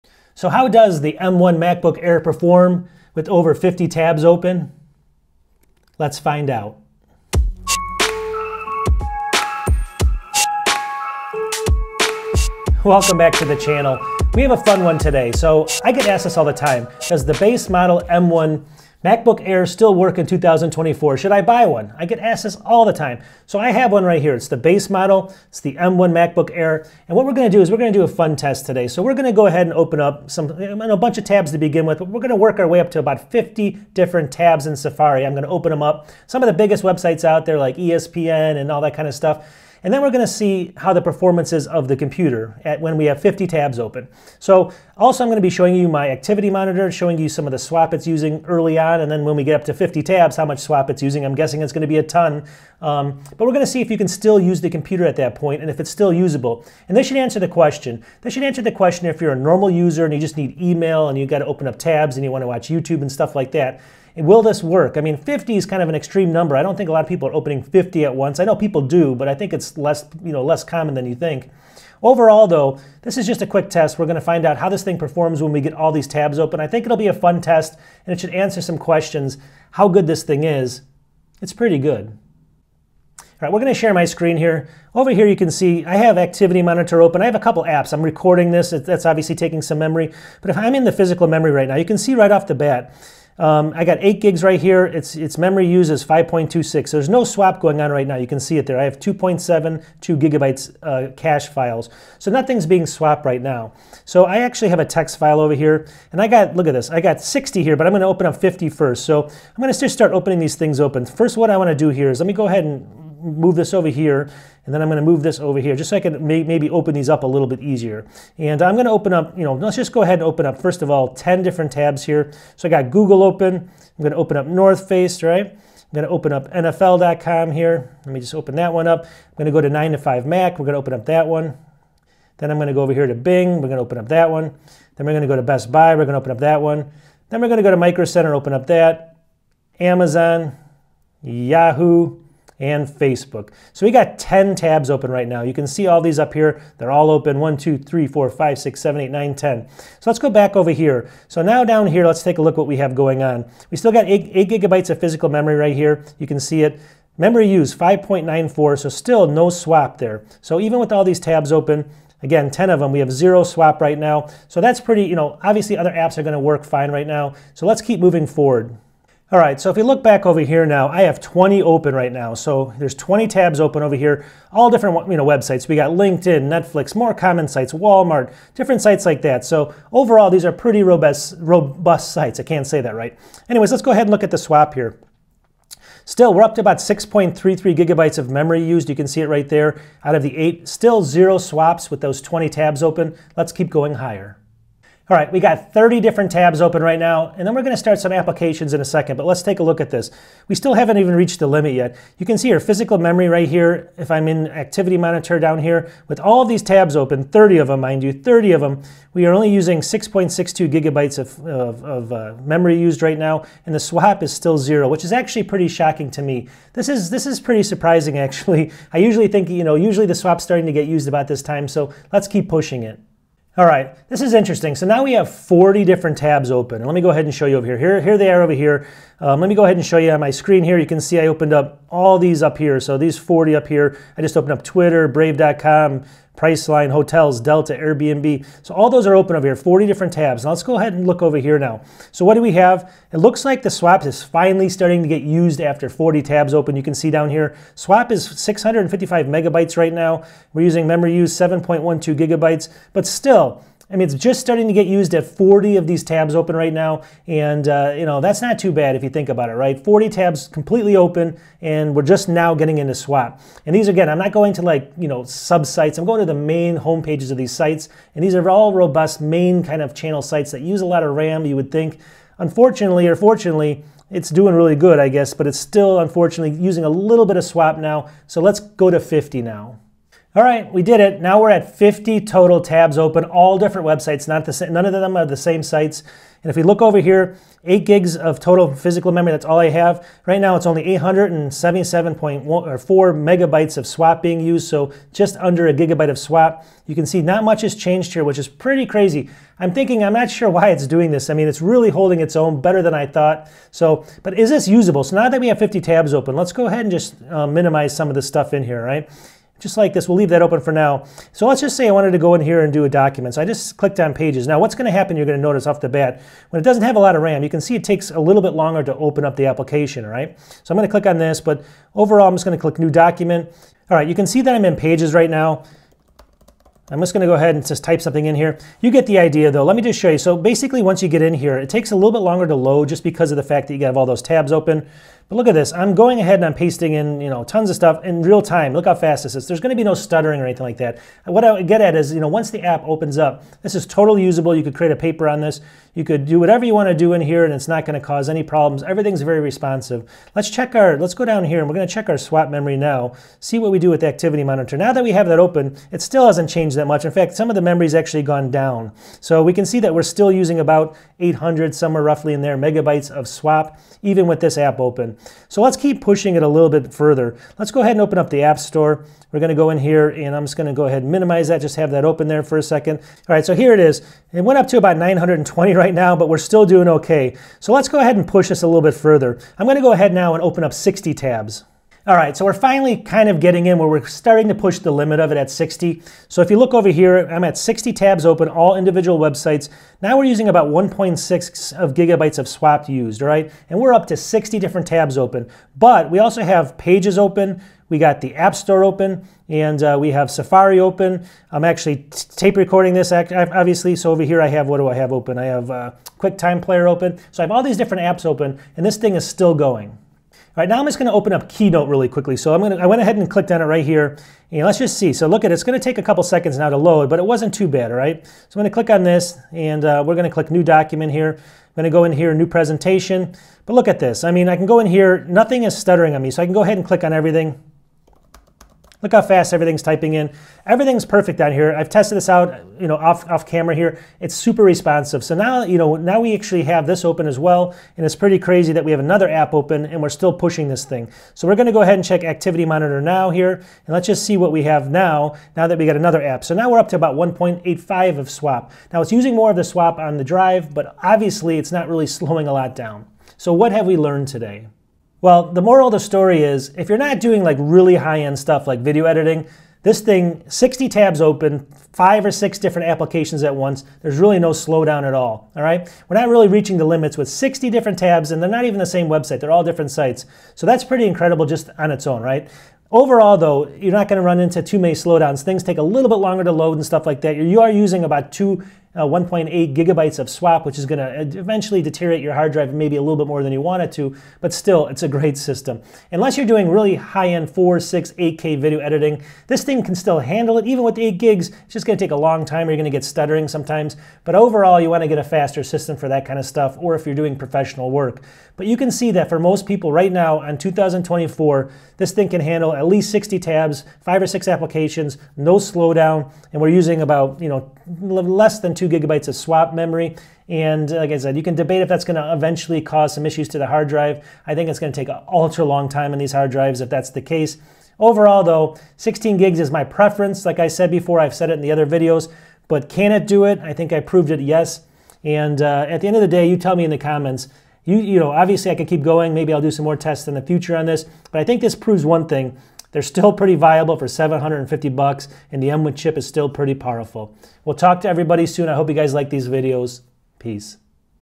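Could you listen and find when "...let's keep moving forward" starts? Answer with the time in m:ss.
2:47.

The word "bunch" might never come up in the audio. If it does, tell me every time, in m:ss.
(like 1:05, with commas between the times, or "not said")
0:30.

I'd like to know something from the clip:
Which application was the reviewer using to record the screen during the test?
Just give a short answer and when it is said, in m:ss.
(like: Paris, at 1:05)
QuickTime Player, at 6:46.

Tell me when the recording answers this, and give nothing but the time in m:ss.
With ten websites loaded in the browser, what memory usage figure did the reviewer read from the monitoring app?
2:37.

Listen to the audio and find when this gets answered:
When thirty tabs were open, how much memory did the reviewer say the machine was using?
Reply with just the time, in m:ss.
3:29.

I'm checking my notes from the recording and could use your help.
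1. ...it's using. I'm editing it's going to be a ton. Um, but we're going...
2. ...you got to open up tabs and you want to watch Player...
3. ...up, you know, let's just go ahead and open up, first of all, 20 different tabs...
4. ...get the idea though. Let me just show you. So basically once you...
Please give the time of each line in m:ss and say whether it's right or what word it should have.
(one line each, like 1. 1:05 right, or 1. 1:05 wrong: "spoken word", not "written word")
1. 0:50 wrong: "guessing", not "editing"
2. 1:01 wrong: "YouTube", not "Player"
3. 1:59 wrong: "10", not "20"
4. 5:28 right.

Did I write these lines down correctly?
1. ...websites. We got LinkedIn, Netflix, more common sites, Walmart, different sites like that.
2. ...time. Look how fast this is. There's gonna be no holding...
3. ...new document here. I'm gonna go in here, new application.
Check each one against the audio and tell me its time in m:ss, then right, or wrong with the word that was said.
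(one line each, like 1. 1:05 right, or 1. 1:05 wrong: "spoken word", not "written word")
1. 2:55 right
2. 5:38 wrong: "stuttering", not "holding"
3. 7:00 wrong: "presentation", not "application".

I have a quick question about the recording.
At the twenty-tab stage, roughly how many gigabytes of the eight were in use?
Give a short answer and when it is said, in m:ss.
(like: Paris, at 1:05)
6.33, at 3:06.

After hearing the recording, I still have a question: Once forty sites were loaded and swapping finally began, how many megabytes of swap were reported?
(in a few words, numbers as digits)
655.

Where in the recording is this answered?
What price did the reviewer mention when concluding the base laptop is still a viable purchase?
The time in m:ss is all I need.
8:54.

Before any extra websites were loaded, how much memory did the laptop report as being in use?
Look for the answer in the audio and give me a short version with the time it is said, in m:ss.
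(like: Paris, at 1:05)
5.26 GB, at 1:36.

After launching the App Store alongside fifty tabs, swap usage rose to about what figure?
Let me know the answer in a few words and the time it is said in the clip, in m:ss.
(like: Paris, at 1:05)
920, at 6:14.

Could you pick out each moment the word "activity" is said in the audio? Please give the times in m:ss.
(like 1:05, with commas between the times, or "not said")
0:46, 1:26, 3:24, 5:54, 7:22.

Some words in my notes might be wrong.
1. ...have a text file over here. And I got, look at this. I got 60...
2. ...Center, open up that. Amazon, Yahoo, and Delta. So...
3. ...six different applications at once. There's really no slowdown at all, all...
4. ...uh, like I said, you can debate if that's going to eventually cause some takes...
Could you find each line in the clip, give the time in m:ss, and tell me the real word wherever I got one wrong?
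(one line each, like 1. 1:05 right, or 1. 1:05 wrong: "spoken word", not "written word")
1. 1:44 right
2. 2:18 wrong: "Facebook", not "Delta"
3. 7:42 right
4. 8:30 wrong: "issues", not "takes".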